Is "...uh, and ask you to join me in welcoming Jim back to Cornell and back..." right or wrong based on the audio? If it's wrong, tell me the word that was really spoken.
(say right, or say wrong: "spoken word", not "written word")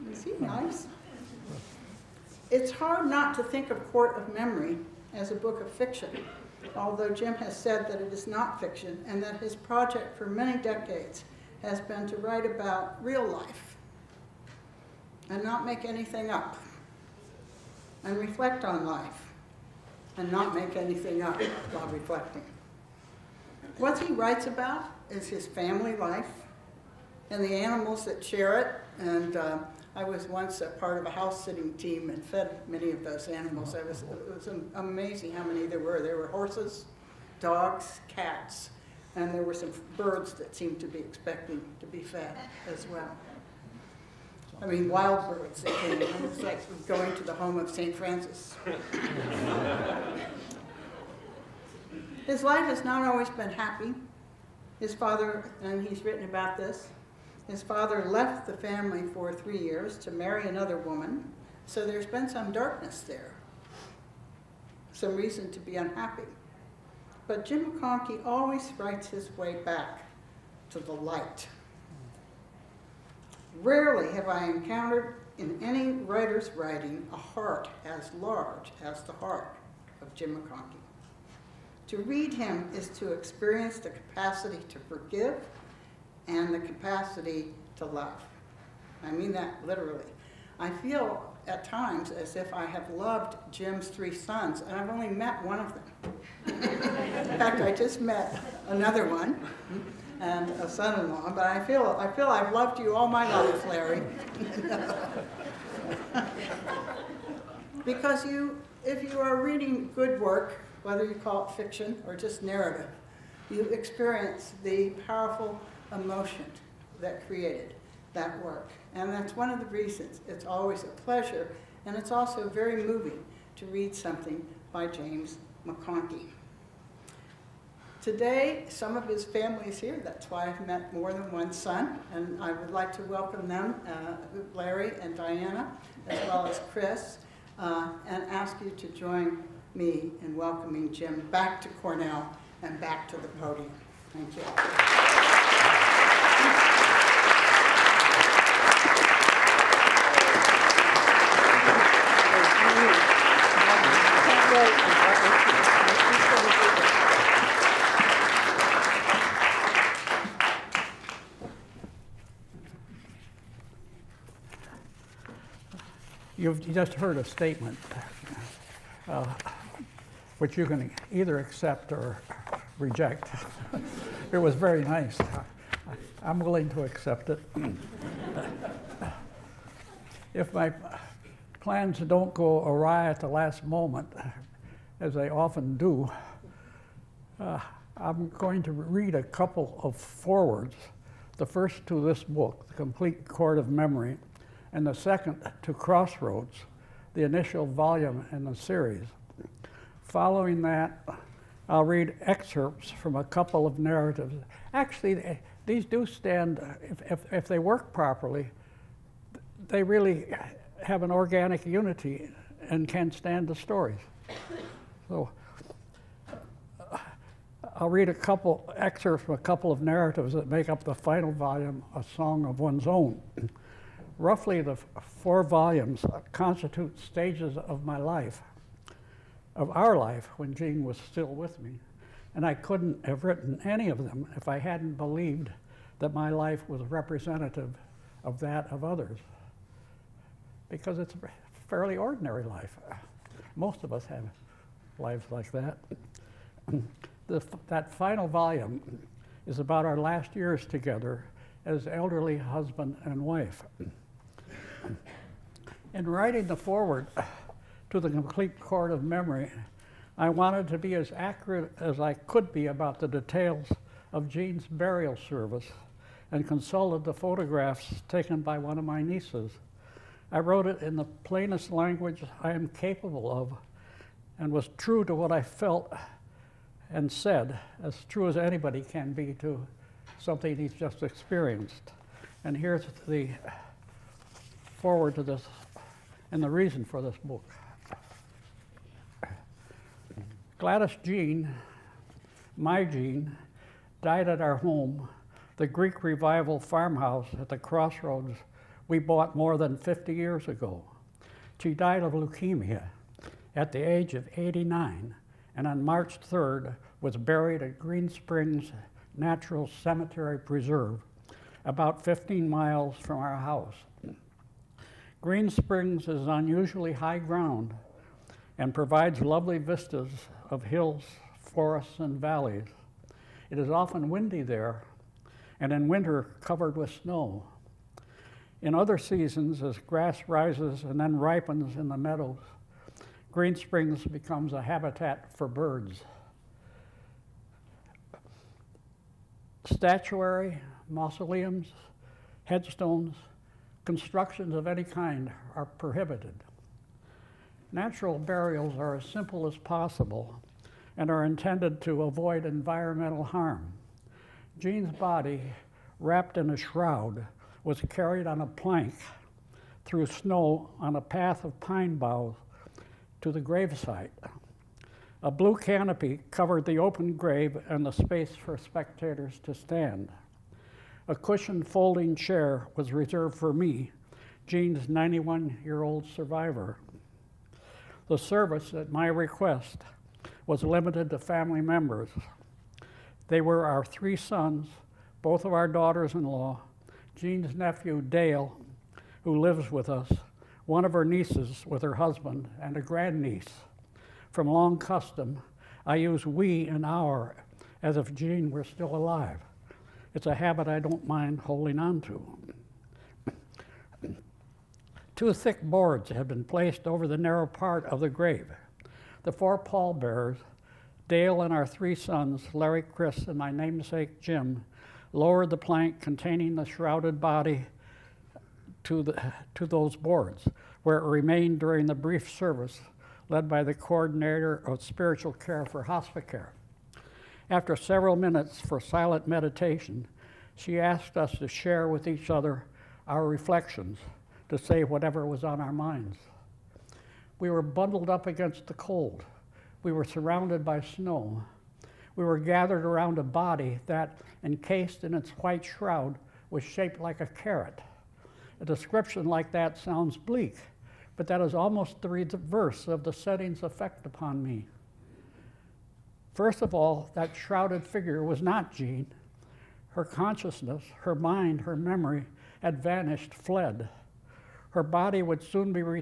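right.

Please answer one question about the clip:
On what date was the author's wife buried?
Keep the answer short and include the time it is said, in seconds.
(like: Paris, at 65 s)
March 3rd, at 305 s.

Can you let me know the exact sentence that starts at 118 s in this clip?
And that's one of the reasons.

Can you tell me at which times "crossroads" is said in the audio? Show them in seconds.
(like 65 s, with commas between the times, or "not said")
195 s, 297 s.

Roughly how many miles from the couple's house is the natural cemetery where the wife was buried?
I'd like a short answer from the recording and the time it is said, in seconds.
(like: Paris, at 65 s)
15 miles, at 312 s.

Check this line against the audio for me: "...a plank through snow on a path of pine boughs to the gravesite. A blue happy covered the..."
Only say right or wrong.
wrong.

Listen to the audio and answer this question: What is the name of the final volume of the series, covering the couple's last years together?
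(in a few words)
A Song of One's Own.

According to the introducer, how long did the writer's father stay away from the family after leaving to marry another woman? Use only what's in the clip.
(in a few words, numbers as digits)
3 years.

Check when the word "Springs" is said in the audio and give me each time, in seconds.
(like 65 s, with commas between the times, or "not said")
308 s, 315 s, 333 s.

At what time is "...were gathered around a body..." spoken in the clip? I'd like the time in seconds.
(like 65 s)
442 s.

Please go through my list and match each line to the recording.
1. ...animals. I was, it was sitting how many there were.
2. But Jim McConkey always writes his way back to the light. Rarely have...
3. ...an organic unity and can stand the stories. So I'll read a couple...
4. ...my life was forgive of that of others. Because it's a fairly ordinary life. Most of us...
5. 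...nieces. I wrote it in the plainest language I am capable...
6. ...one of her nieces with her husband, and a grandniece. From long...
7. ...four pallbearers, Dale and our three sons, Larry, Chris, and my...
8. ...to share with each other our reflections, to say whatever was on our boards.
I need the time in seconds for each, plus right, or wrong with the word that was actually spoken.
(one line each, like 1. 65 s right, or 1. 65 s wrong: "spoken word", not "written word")
1. 33 s wrong: "amazing", not "sitting"
2. 67 s right
3. 211 s right
4. 236 s wrong: "representative", not "forgive"
5. 269 s right
6. 390 s right
7. 409 s right
8. 431 s wrong: "minds", not "boards".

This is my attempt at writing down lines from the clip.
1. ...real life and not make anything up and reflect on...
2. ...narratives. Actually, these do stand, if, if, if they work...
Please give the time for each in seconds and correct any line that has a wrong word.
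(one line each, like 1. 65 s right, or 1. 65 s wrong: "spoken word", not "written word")
1. 13 s right
2. 203 s right.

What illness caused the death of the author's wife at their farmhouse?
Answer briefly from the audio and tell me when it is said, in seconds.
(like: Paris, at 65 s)
Leukemia, at 302 s.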